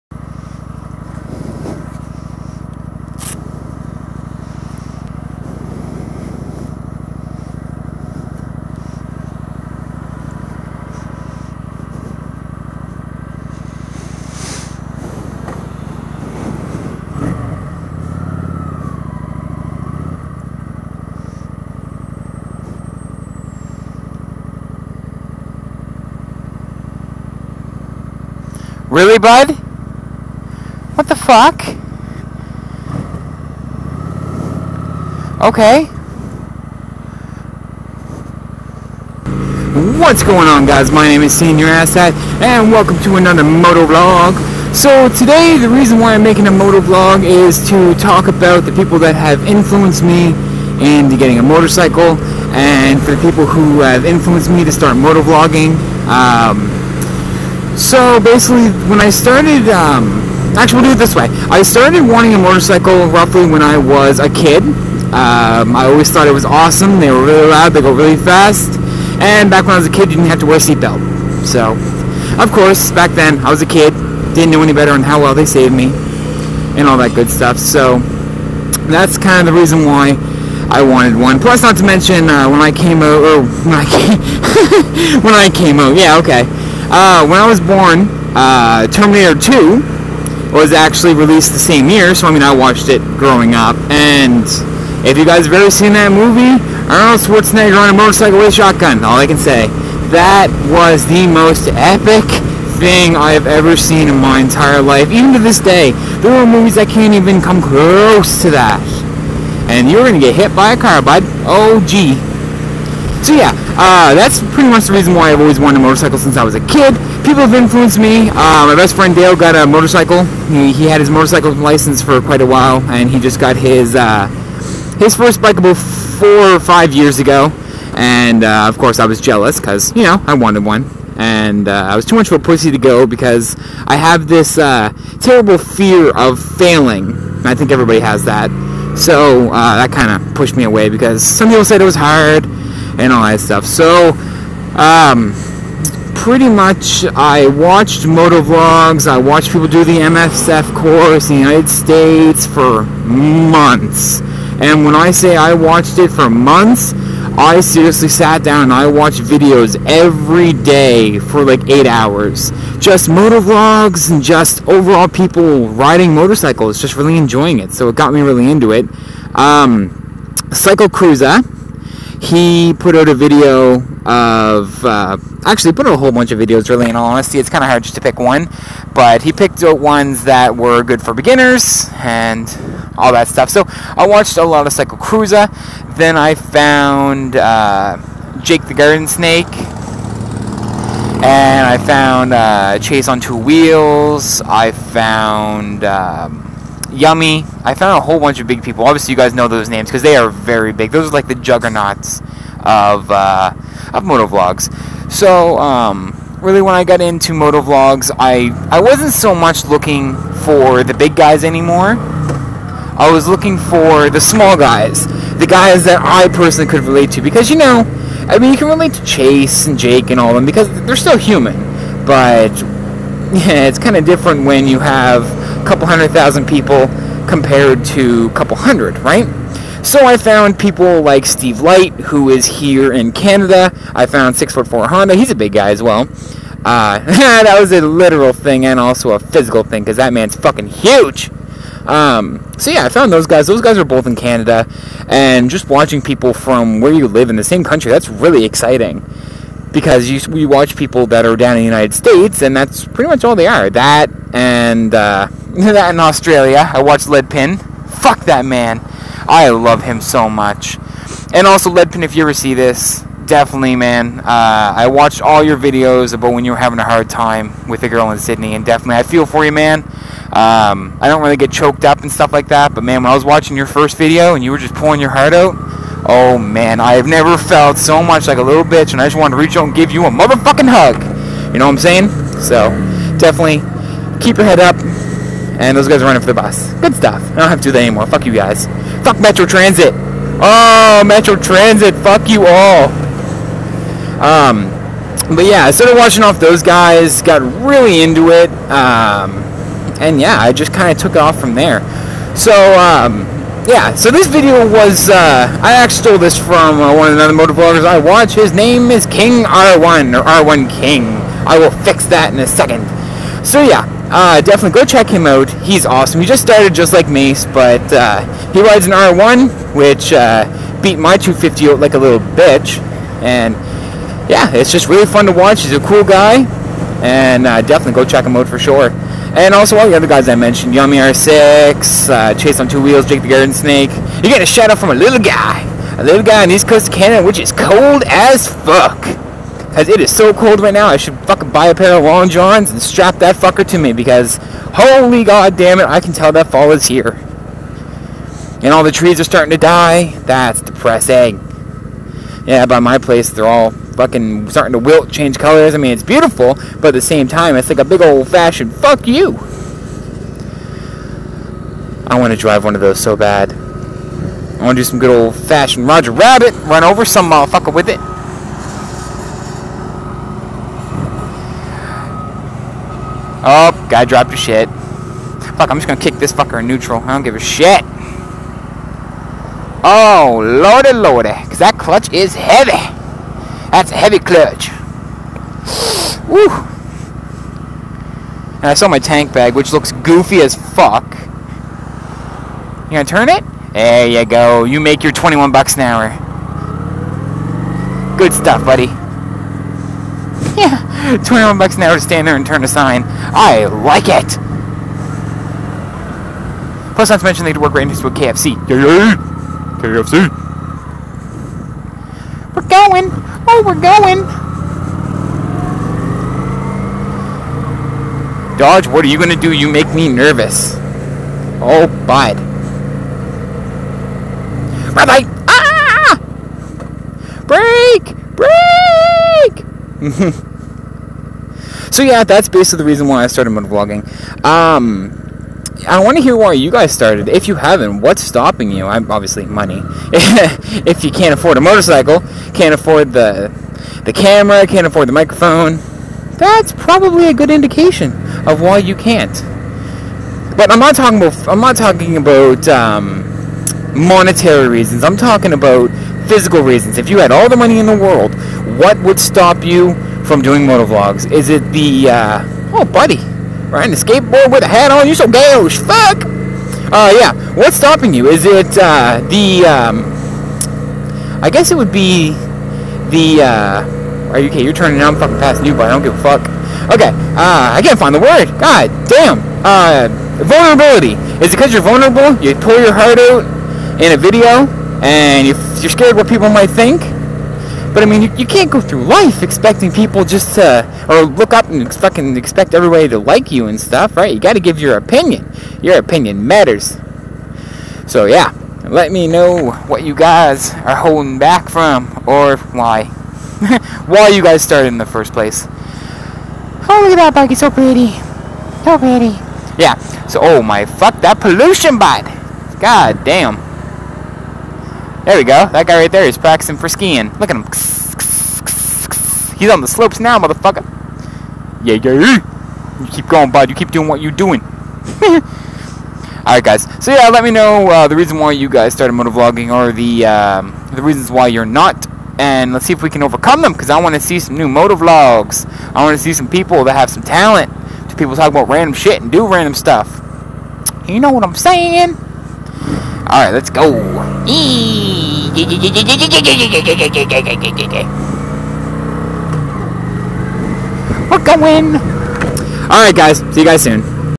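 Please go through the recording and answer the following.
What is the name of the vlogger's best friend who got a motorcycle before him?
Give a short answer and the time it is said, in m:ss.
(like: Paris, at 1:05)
Dale, at 1:59.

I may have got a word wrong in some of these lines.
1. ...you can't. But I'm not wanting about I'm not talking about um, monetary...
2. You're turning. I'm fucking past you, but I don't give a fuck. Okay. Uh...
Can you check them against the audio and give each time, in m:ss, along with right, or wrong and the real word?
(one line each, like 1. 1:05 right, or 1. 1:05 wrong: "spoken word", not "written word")
1. 7:28 wrong: "talking", not "wanting"
2. 7:54 right.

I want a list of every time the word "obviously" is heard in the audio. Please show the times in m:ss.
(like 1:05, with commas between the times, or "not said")
3:18, 7:19.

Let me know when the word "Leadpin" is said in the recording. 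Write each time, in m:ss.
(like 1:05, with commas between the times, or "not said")
4:17, 4:21.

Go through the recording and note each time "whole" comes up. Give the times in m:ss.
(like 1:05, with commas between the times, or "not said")
2:55, 3:18.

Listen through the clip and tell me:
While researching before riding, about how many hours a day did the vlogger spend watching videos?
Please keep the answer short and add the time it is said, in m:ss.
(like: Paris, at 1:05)
8, at 2:41.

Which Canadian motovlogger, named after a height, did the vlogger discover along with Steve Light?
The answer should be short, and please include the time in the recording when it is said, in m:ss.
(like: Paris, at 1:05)
Six foot four Honda, at 3:54.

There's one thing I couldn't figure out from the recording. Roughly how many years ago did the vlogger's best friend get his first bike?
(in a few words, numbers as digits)
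4 or 5.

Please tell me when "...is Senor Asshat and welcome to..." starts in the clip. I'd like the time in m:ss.
0:41.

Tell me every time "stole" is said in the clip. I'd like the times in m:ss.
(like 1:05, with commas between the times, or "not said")
5:06.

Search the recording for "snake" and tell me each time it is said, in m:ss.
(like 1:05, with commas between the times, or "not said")
3:09, 5:33.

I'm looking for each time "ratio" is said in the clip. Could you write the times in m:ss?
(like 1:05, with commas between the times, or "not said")
not said.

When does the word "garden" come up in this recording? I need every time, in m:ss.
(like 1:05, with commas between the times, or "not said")
3:08, 5:33.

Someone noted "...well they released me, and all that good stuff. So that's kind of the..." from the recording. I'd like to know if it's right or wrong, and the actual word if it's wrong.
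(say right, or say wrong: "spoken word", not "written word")
wrong: "saved", not "released".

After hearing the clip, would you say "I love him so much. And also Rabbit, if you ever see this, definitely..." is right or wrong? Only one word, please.
wrong.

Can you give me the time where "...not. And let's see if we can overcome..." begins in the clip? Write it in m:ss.
8:51.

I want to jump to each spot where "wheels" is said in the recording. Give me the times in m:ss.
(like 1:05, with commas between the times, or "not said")
3:13, 5:32.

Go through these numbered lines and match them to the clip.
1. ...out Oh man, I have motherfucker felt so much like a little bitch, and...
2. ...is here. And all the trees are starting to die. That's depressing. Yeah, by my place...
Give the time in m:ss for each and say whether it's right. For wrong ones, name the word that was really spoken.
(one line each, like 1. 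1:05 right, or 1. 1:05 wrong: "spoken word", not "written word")
1. 4:35 wrong: "never", not "motherfucker"
2. 5:46 right.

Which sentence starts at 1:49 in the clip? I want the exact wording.
And you're gonna get hit by a car, bud.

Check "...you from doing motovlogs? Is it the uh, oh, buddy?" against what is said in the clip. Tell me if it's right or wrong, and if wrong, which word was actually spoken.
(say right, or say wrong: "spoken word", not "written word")
right.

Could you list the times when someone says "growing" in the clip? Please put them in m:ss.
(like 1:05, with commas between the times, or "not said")
1:33.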